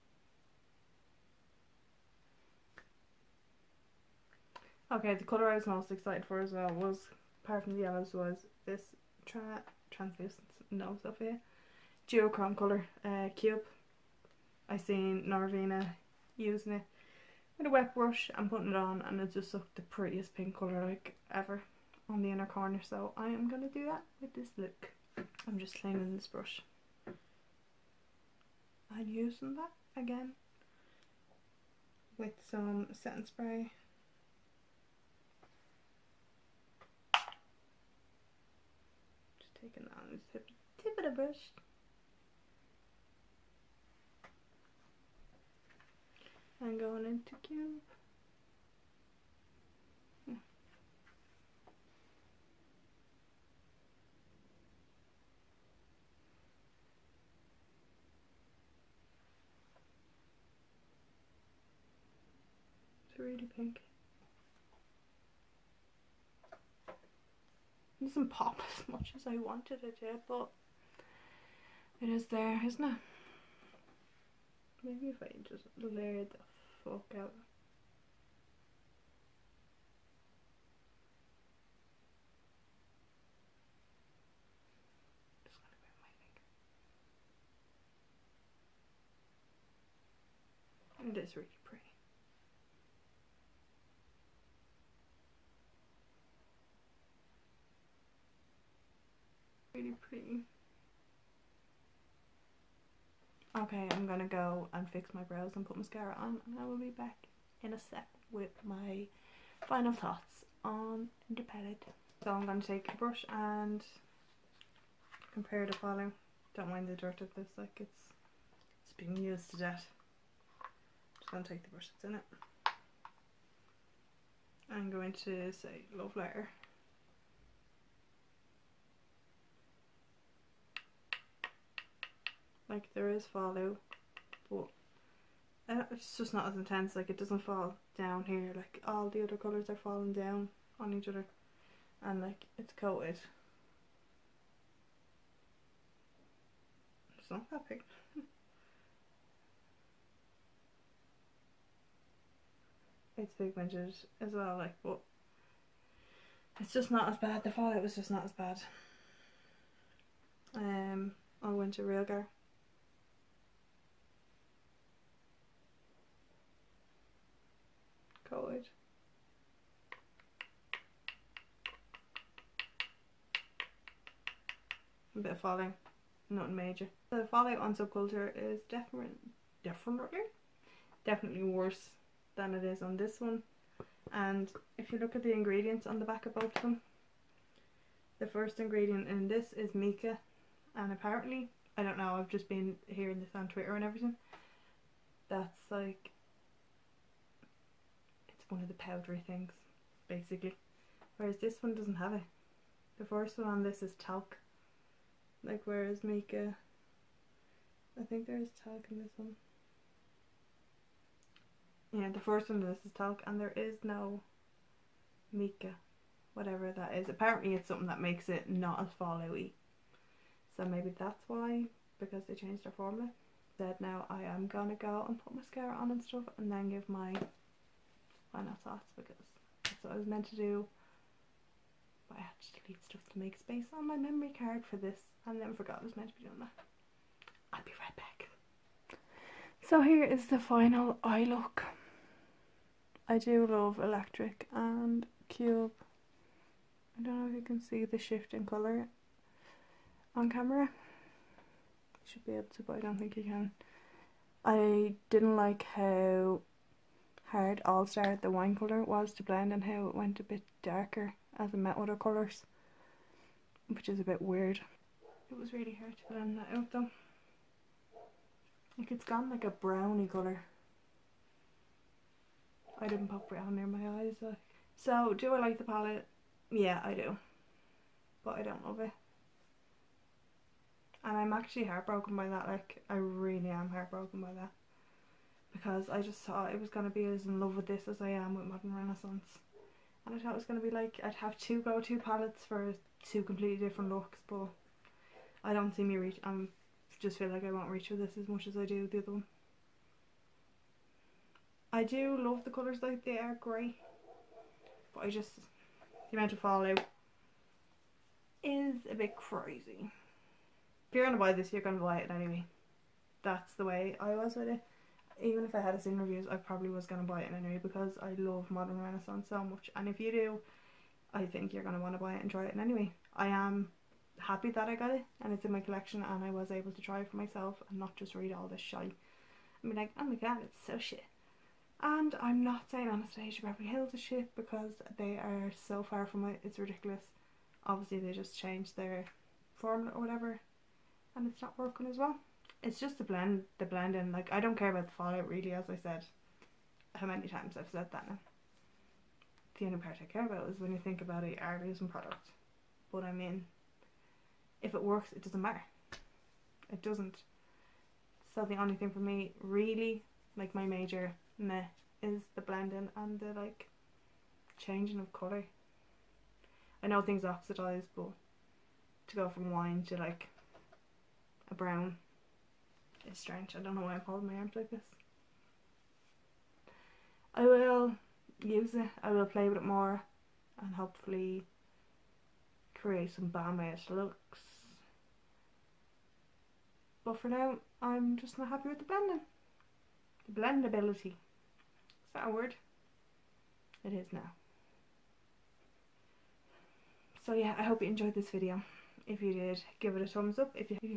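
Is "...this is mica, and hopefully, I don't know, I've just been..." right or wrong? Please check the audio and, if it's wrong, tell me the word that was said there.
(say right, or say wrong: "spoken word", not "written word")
wrong: "apparently", not "hopefully".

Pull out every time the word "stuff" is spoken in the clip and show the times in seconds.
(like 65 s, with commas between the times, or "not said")
226 s, 232 s.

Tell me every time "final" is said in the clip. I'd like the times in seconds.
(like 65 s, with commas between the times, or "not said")
109 s, 228 s, 240 s.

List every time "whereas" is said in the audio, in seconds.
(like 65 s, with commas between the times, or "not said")
201 s, 205 s.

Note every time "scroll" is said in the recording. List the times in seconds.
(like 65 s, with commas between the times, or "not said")
not said.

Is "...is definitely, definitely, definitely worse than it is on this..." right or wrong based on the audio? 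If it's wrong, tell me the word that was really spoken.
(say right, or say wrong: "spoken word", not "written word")
right.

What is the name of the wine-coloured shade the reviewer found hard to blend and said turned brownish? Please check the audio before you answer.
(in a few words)
All-Star.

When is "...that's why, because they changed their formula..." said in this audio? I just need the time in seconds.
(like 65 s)
220 s.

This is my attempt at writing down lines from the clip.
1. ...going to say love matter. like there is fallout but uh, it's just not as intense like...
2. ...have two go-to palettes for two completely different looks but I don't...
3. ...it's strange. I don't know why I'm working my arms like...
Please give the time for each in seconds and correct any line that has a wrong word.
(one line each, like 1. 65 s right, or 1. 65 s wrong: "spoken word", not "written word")
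1. 124 s wrong: "letter", not "matter"
2. 291 s right
3. 373 s wrong: "holding", not "working".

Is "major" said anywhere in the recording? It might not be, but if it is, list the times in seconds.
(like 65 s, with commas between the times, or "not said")
176 s, 360 s.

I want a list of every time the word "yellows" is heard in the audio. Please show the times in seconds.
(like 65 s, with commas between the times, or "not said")
7 s.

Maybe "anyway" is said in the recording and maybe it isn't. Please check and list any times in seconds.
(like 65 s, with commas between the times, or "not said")
312 s, 317 s, 322 s.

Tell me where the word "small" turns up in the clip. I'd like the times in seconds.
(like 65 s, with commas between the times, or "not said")
not said.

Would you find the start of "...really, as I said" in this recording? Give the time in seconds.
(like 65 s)
345 s.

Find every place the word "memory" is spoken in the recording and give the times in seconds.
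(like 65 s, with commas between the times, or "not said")
233 s.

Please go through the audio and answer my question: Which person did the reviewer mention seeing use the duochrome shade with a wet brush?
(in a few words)
Norvina.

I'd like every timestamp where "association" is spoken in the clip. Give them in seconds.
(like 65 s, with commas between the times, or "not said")
not said.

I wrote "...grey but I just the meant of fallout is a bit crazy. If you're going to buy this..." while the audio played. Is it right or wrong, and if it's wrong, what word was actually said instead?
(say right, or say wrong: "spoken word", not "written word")
wrong: "amount", not "meant".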